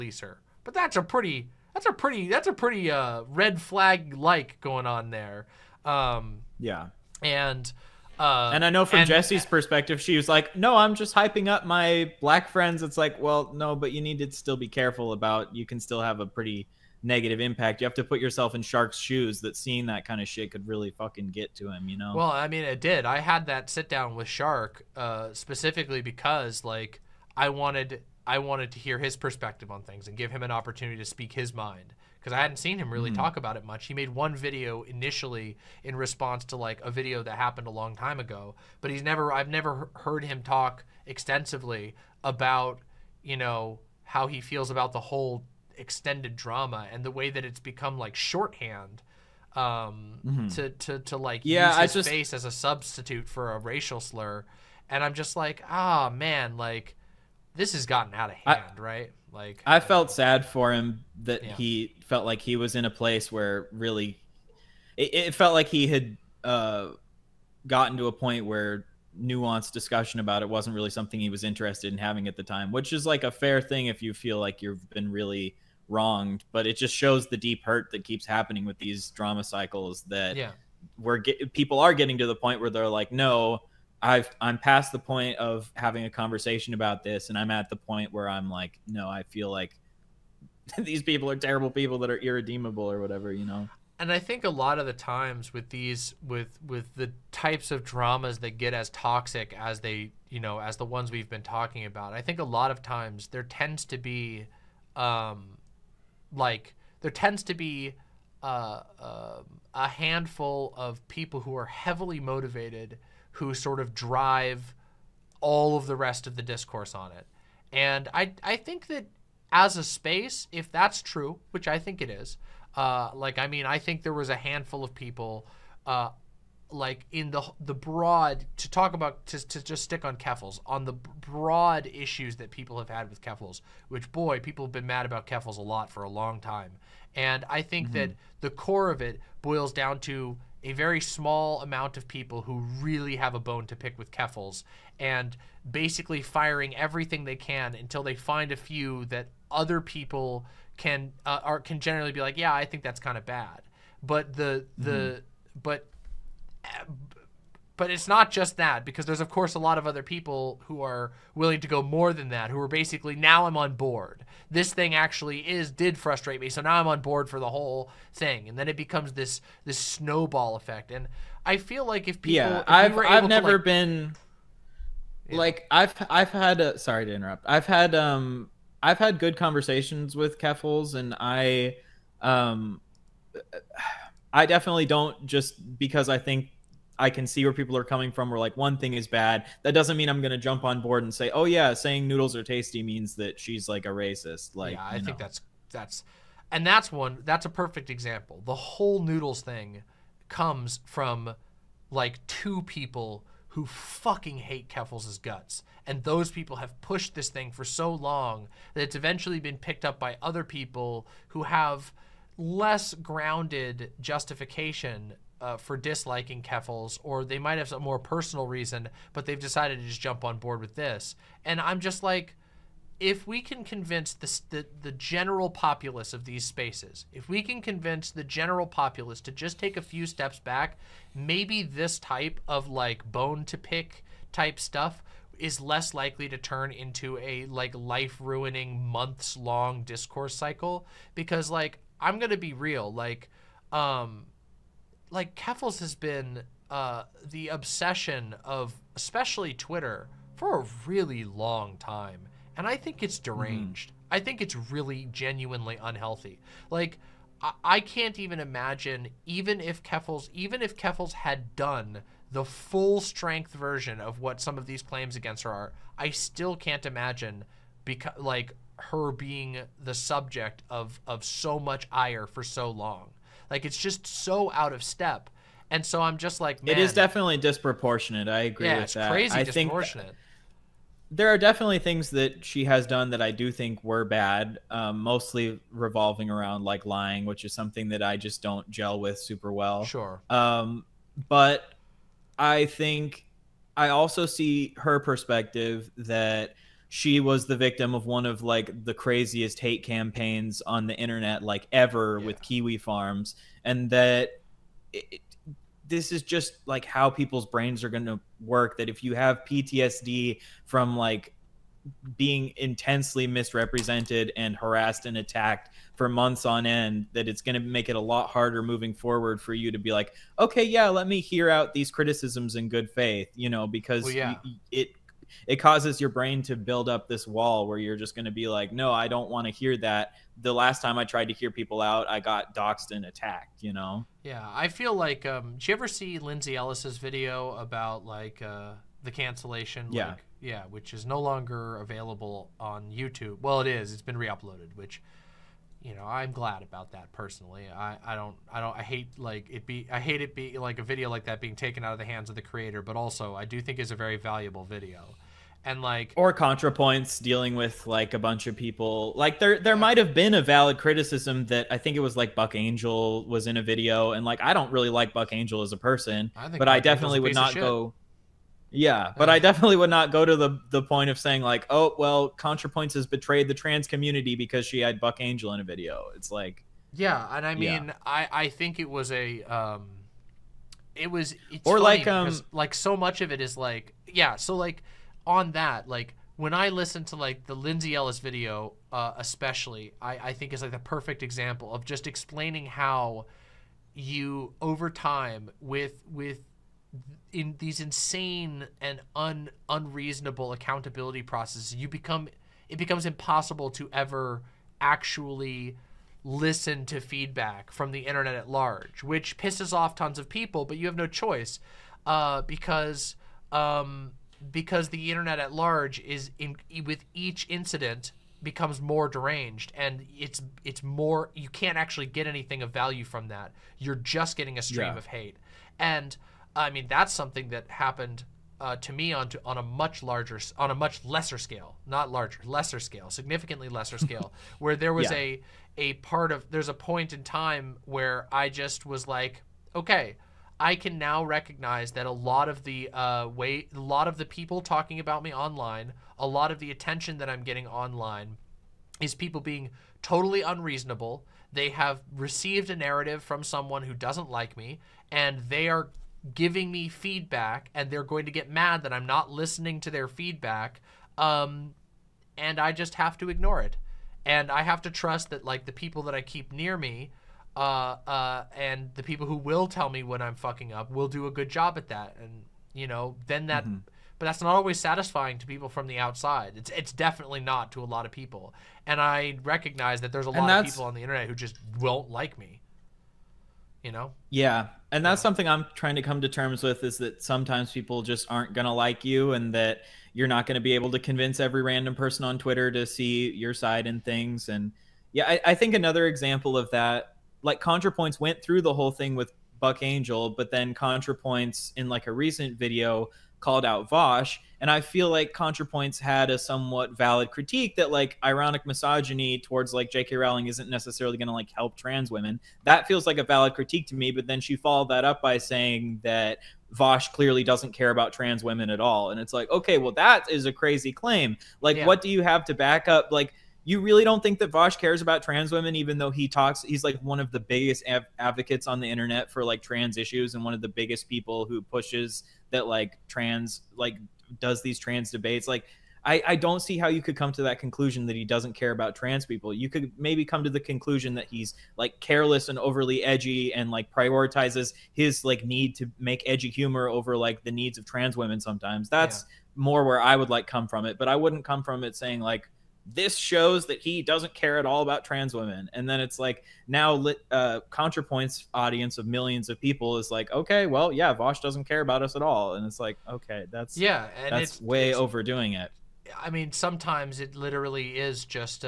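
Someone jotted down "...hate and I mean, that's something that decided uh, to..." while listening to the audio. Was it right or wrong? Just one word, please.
wrong.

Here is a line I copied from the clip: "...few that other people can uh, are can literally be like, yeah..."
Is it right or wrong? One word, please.
wrong.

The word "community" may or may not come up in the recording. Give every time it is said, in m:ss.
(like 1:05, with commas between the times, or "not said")
6:13.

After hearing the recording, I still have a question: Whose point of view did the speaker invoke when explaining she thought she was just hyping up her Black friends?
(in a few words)
Jessie.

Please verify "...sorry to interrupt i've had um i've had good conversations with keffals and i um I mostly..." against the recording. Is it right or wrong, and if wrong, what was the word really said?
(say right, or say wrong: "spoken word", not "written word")
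wrong: "definitely", not "mostly".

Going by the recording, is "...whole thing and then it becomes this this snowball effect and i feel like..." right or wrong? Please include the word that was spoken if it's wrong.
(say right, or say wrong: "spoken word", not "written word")
right.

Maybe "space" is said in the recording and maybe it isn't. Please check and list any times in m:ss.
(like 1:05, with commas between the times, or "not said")
1:59, 3:46.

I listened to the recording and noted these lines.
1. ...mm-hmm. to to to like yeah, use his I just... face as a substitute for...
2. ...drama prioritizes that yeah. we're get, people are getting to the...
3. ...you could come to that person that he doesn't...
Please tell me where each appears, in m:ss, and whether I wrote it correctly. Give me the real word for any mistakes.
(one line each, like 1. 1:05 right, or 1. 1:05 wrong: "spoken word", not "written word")
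1. 0:50 right
2. 1:19 wrong: "cycles", not "prioritizes"
3. 8:56 wrong: "conclusion", not "person".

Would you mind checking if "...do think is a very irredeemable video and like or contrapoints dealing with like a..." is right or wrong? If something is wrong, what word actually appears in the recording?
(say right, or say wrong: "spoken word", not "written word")
wrong: "valuable", not "irredeemable".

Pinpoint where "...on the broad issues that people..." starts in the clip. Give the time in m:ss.
2:10.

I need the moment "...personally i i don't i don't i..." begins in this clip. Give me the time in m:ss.
5:47.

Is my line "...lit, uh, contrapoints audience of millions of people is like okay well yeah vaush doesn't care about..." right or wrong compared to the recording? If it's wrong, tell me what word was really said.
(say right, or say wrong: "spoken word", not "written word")
right.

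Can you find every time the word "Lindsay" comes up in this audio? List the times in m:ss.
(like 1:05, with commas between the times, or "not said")
5:36, 6:27.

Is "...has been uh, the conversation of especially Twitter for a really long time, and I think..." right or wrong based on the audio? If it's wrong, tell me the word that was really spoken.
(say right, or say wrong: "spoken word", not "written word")
wrong: "obsession", not "conversation".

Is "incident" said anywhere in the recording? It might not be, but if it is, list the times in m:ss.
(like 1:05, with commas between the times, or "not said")
6:57.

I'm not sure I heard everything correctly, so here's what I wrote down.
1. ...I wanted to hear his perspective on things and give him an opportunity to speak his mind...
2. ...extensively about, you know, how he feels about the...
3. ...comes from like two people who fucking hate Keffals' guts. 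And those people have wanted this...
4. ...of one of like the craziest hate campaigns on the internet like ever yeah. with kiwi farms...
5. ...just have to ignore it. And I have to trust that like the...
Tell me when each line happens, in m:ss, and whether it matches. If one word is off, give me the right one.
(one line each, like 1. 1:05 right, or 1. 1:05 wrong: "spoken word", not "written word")
1. 0:28 right
2. 0:41 right
3. 3:20 wrong: "pushed", not "wanted"
4. 4:57 right
5. 7:42 right.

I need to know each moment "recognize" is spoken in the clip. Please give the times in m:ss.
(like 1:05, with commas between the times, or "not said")
7:21, 7:59.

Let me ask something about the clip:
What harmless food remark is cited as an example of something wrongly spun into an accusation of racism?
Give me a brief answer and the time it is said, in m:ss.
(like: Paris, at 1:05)
noodles are tasty, at 3:12.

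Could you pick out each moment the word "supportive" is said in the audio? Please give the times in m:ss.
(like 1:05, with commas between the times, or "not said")
not said.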